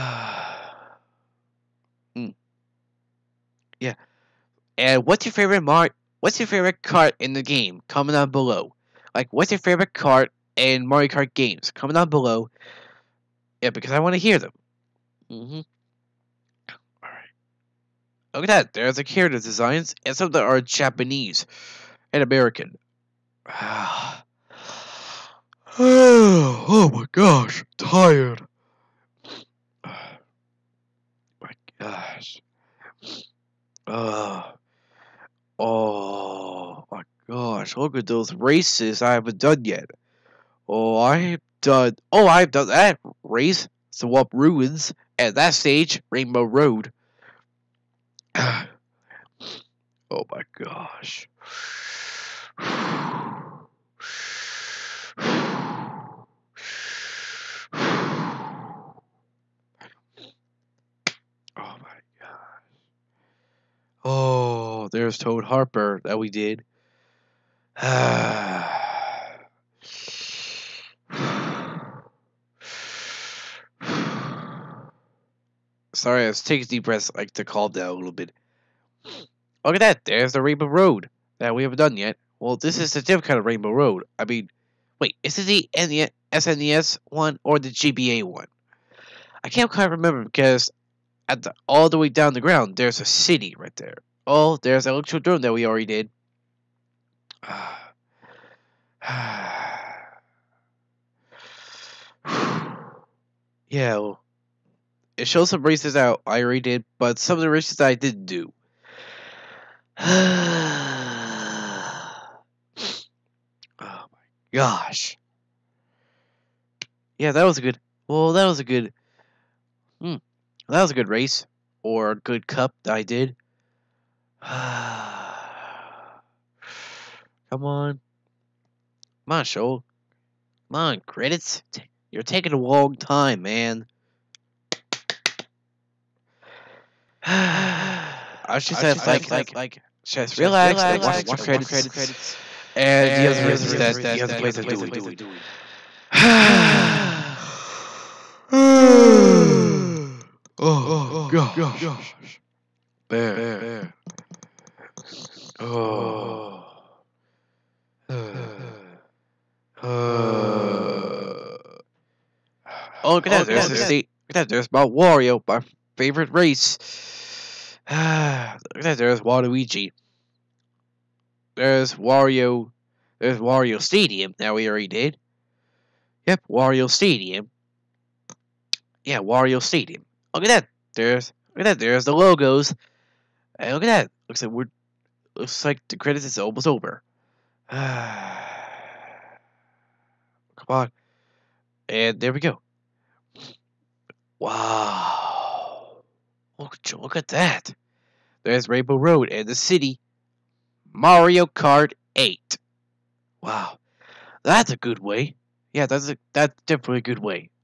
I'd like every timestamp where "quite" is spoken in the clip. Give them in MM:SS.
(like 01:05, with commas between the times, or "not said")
01:29.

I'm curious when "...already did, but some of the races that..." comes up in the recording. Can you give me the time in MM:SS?
01:46.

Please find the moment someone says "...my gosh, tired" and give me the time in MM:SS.
00:26.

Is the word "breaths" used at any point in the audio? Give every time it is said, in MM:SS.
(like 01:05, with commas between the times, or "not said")
01:16.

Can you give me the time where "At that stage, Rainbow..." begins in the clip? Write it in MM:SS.
00:45.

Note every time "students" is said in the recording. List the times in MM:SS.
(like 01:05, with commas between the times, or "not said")
not said.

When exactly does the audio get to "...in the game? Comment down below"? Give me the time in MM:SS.
00:07.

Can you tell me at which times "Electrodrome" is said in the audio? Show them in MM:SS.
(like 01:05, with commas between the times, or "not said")
01:34.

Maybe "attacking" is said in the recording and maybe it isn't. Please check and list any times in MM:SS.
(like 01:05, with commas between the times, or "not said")
not said.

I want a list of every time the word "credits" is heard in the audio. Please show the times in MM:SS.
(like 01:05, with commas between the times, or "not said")
02:11, 02:21, 03:05.